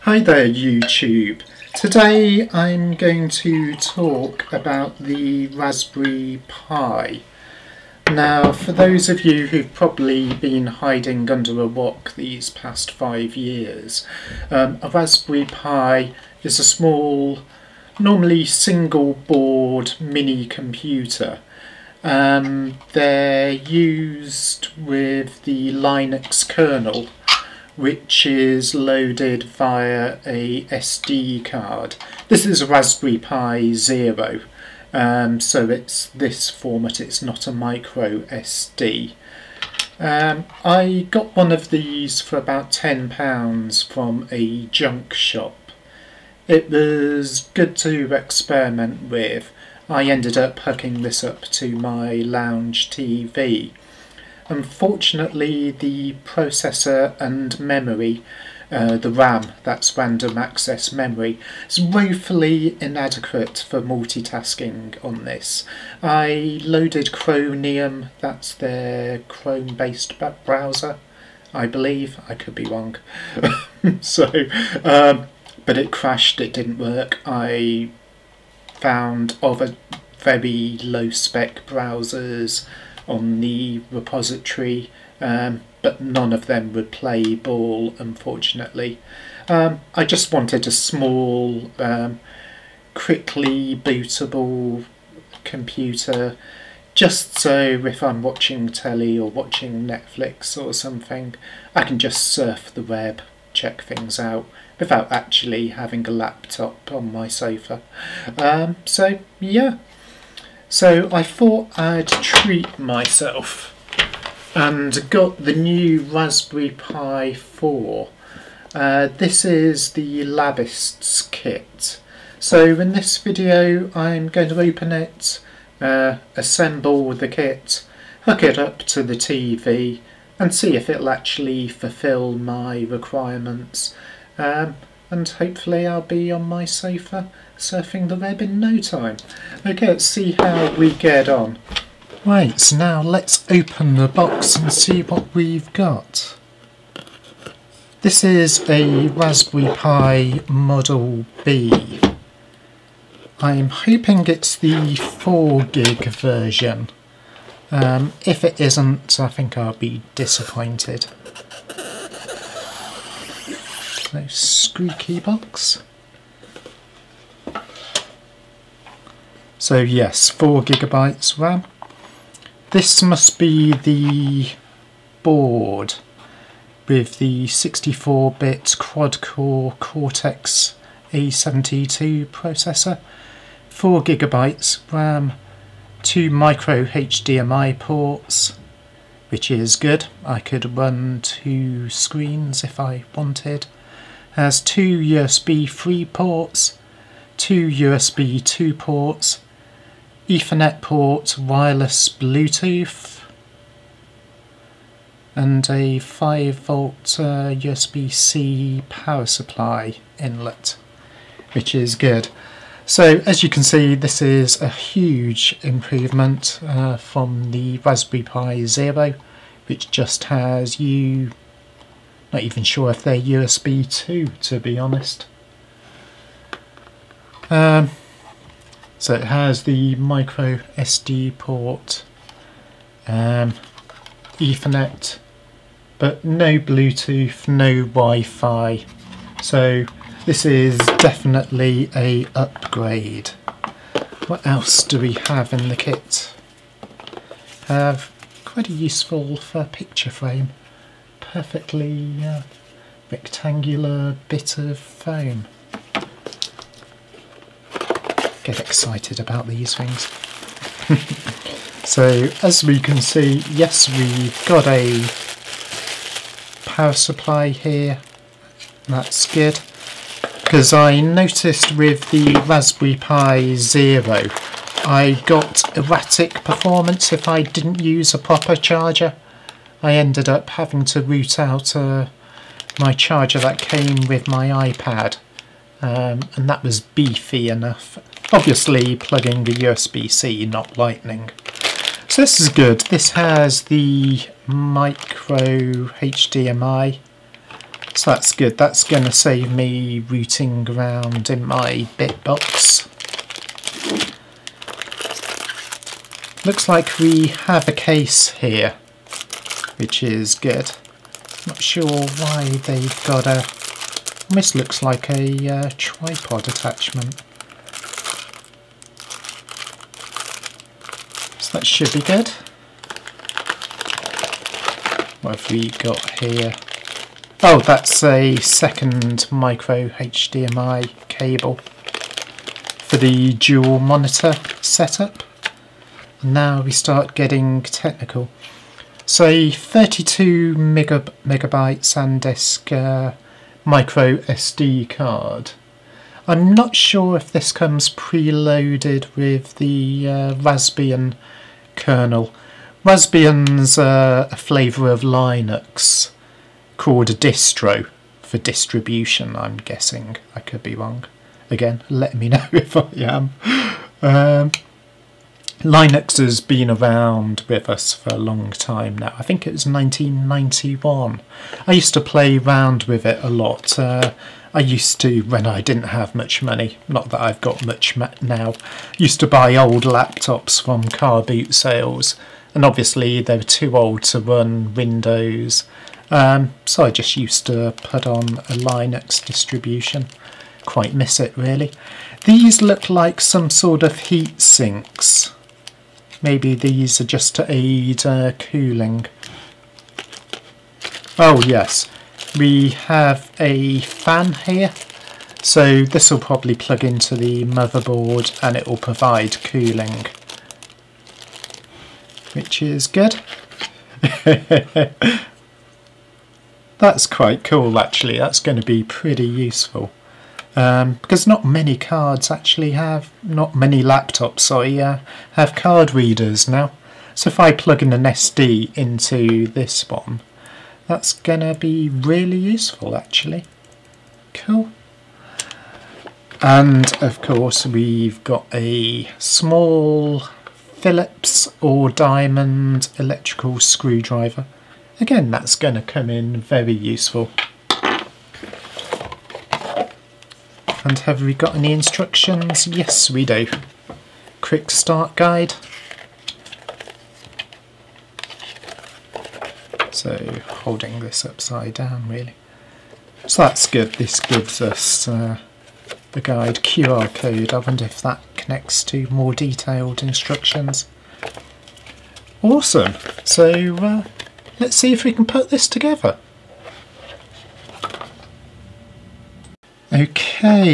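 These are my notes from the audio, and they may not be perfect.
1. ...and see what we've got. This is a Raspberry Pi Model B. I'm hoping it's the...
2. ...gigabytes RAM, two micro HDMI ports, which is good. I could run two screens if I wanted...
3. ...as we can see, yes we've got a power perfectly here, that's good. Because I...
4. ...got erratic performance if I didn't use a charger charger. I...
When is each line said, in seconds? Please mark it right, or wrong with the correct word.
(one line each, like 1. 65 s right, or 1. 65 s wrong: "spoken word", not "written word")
1. 144 s right
2. 184 s right
3. 262 s wrong: "supply", not "perfectly"
4. 275 s wrong: "proper", not "charger".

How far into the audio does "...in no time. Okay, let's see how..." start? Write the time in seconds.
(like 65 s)
138 s.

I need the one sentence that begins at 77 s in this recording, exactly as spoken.
I found other very low-spec browsers on the repository um, but none of them would play ball unfortunately.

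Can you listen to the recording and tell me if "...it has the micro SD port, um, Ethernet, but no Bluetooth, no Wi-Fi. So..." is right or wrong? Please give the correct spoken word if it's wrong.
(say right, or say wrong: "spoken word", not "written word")
right.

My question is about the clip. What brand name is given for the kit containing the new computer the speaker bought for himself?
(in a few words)
Labists.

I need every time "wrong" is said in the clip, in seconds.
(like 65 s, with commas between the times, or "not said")
72 s, 360 s.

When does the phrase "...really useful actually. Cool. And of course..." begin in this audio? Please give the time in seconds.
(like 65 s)
431 s.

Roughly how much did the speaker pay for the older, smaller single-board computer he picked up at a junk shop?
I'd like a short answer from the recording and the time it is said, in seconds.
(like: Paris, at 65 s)
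£10, at 42 s.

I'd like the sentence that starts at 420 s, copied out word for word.
Um, because not many cards actually have, not many laptops, sorry, uh, have card readers now.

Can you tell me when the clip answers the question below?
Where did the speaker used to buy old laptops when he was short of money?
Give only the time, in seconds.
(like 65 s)
380 s.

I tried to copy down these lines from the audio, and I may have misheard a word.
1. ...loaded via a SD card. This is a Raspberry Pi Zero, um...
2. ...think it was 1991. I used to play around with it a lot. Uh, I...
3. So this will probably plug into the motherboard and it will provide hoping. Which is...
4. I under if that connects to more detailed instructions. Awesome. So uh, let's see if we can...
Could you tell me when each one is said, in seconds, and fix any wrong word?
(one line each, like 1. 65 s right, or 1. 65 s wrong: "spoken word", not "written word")
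1. 28 s right
2. 369 s right
3. 405 s wrong: "cooling", not "hoping"
4. 467 s wrong: "wonder", not "under".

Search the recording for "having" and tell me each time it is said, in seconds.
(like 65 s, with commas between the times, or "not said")
105 s, 280 s.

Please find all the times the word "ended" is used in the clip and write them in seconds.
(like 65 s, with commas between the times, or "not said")
50 s, 279 s.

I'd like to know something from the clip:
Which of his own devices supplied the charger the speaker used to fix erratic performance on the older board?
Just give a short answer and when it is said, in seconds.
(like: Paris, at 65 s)
iPad, at 284 s.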